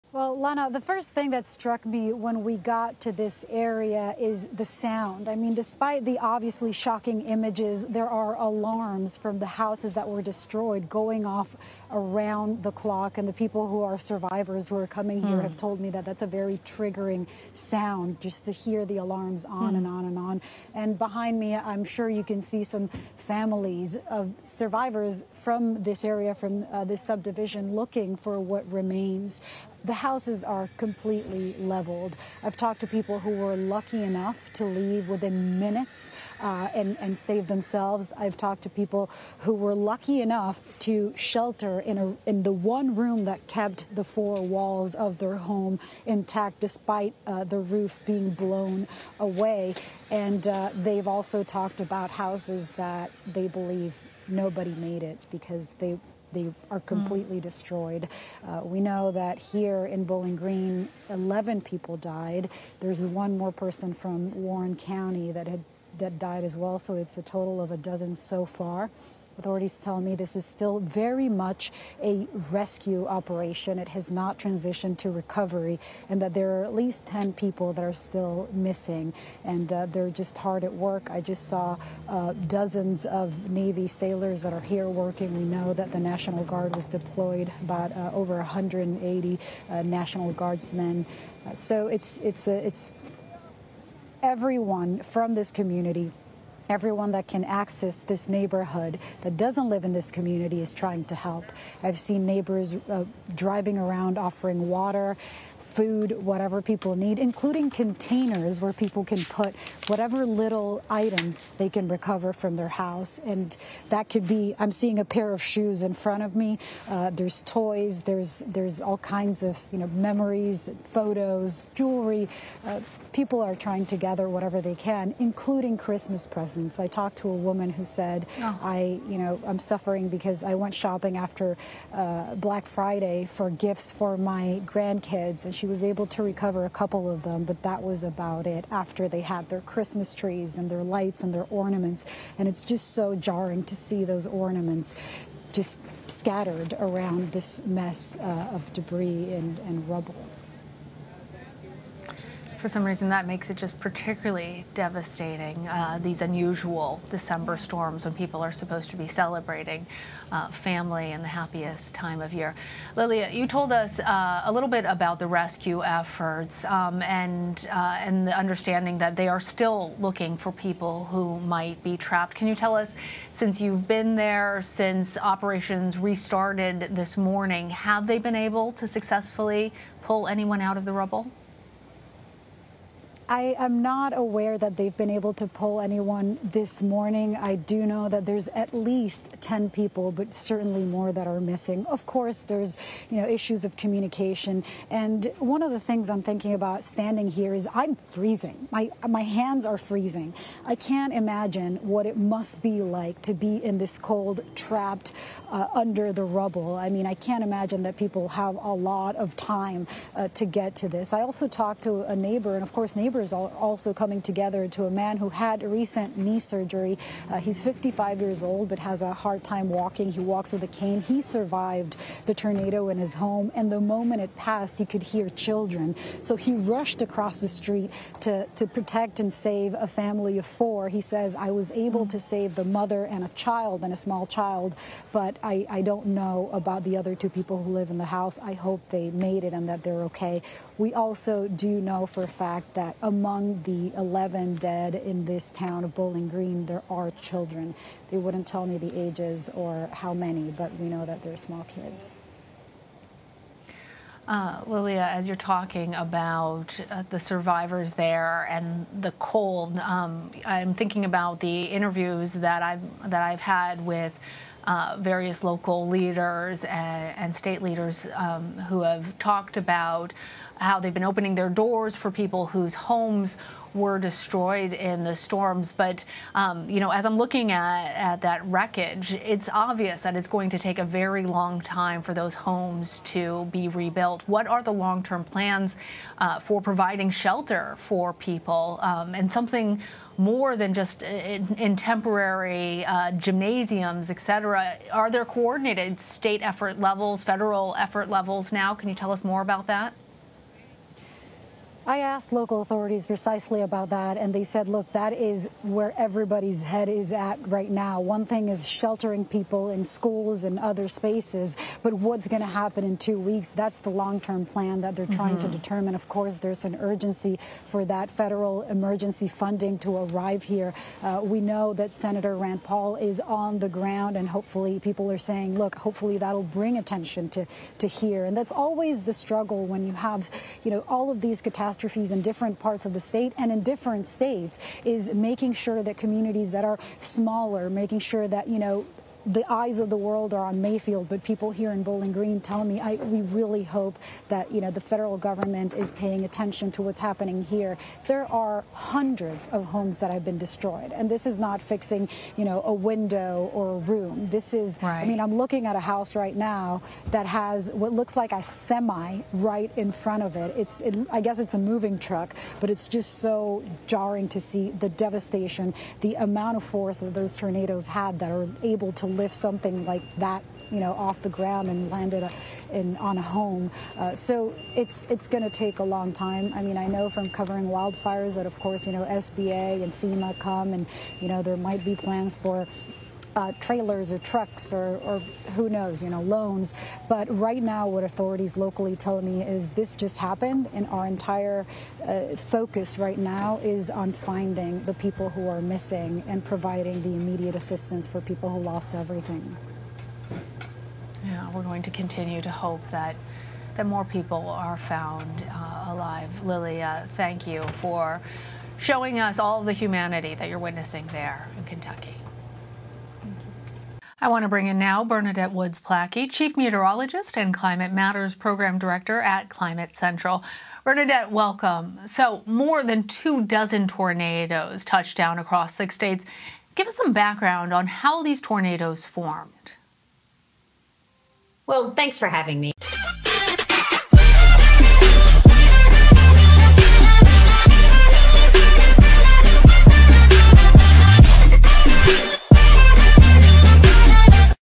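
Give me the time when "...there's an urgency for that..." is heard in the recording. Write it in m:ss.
5:16.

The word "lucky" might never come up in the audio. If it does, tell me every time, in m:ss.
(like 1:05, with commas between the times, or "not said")
0:33, 0:39.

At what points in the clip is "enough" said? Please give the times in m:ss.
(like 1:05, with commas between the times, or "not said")
0:34, 0:40.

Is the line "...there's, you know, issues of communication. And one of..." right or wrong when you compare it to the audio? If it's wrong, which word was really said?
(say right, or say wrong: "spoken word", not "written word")
right.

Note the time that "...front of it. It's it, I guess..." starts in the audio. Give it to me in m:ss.
5:59.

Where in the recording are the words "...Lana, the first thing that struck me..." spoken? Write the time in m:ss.
0:00.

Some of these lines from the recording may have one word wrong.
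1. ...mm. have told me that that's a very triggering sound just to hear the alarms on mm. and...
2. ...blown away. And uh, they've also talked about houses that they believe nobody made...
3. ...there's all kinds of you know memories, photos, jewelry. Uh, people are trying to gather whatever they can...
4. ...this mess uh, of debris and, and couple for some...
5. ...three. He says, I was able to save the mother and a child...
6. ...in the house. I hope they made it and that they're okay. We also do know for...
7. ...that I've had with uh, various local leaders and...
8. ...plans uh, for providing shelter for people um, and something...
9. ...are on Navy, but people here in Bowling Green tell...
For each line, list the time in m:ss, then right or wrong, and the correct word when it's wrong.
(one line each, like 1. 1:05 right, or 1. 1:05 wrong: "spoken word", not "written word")
1. 0:15 right
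2. 0:48 right
3. 1:58 right
4. 2:27 wrong: "rubble", not "couple"
5. 3:50 wrong: "four", not "three"
6. 3:57 right
7. 4:23 right
8. 4:45 right
9. 5:40 wrong: "Mayfield", not "Navy".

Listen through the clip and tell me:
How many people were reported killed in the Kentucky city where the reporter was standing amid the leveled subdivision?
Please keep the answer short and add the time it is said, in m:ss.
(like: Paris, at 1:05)
11, at 1:01.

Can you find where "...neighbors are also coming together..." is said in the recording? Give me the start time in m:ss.
3:32.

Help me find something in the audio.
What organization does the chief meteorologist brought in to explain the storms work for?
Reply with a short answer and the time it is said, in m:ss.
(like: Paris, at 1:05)
Climate Central, at 6:59.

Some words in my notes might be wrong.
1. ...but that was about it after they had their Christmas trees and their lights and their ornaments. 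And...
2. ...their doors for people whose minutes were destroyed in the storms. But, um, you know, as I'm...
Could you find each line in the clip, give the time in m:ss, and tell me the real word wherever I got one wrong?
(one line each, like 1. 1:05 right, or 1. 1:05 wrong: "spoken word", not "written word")
1. 2:17 right
2. 4:31 wrong: "homes", not "minutes".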